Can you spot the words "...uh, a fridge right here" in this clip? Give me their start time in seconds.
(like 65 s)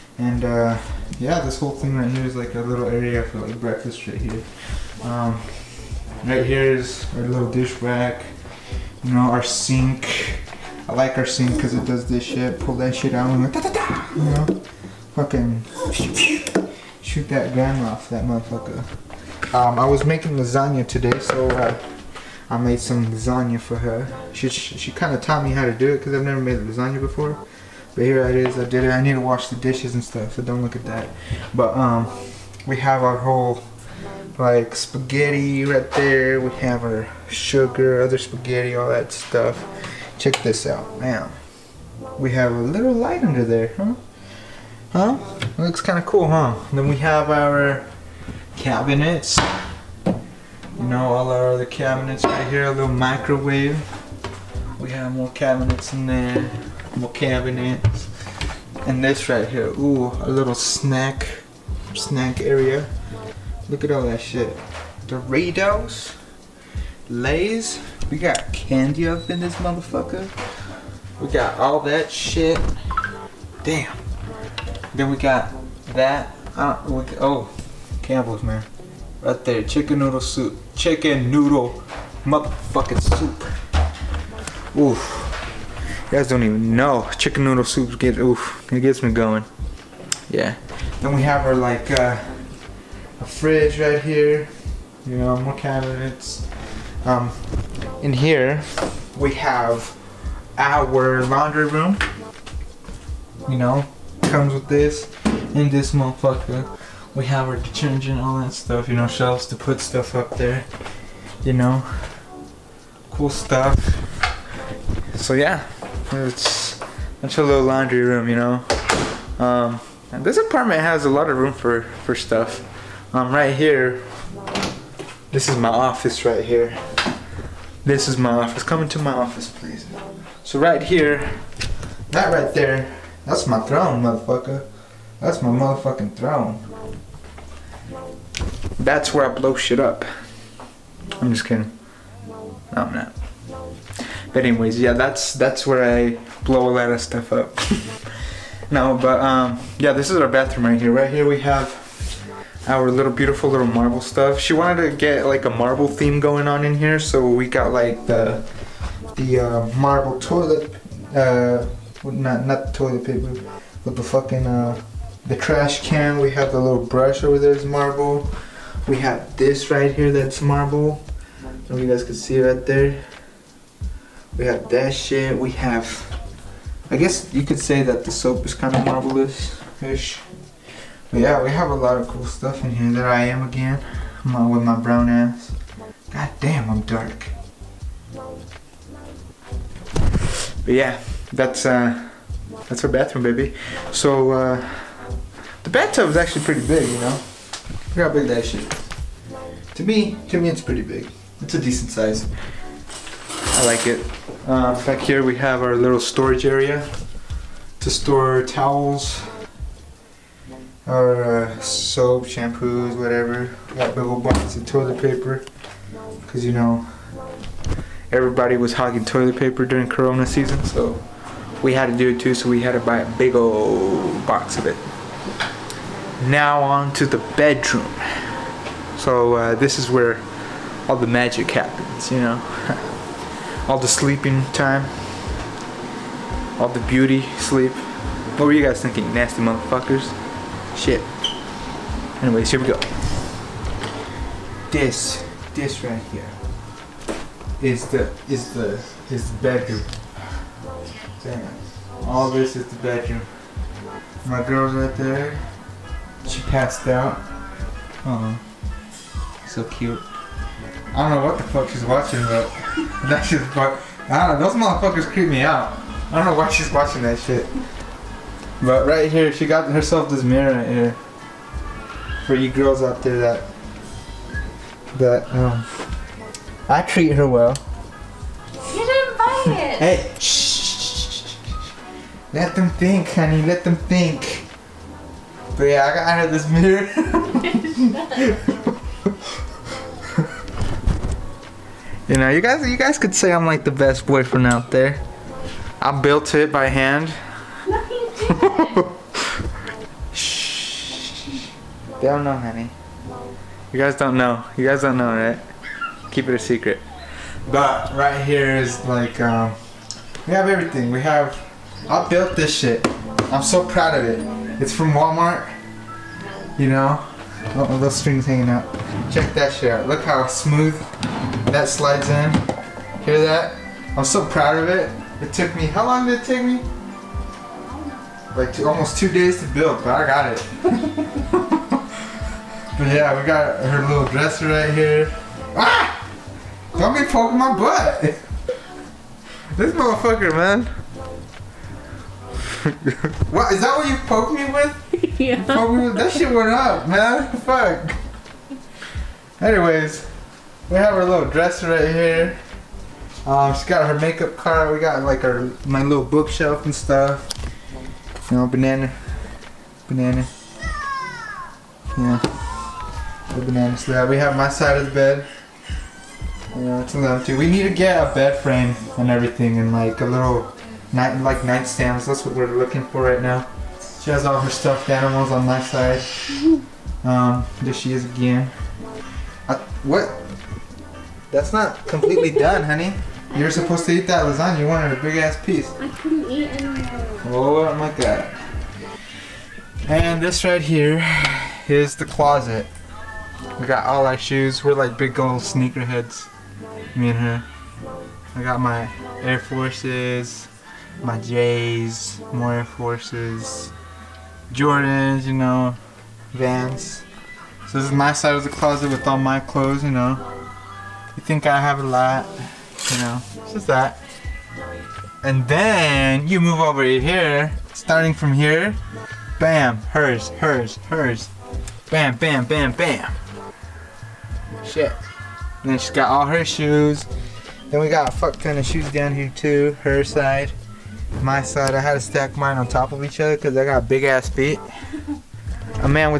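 91 s.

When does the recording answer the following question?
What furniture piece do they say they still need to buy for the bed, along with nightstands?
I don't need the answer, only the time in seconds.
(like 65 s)
368 s.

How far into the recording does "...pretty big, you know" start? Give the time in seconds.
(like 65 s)
196 s.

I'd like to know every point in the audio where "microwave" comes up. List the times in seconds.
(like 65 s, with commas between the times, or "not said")
52 s.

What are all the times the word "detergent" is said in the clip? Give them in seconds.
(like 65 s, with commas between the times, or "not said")
107 s.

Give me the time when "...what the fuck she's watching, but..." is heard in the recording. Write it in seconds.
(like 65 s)
261 s.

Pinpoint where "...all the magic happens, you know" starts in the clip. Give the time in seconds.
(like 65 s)
230 s.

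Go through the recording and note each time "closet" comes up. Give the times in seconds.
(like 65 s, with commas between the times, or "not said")
392 s, 408 s.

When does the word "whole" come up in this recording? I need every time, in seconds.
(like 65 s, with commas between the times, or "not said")
1 s, 33 s.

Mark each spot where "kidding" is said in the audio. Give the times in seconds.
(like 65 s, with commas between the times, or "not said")
141 s.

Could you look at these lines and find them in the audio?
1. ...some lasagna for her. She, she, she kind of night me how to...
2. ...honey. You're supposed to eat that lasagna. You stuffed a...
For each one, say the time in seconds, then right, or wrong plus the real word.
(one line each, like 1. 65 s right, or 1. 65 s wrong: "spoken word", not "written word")
1. 22 s wrong: "taught", not "night"
2. 382 s wrong: "wanted", not "stuffed".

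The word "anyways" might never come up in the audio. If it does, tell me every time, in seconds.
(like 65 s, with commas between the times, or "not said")
144 s, 242 s, 349 s.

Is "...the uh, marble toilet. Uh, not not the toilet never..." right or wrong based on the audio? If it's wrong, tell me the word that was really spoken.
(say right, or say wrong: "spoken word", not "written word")
wrong: "paper", not "never".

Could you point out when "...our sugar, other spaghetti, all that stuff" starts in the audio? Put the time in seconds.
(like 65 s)
36 s.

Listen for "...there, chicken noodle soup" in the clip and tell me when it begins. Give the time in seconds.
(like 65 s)
79 s.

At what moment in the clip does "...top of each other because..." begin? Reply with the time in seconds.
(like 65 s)
432 s.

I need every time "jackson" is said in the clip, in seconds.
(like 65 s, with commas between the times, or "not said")
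not said.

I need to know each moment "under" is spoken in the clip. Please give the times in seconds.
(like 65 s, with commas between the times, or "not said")
43 s.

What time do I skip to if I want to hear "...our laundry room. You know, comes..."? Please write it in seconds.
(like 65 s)
100 s.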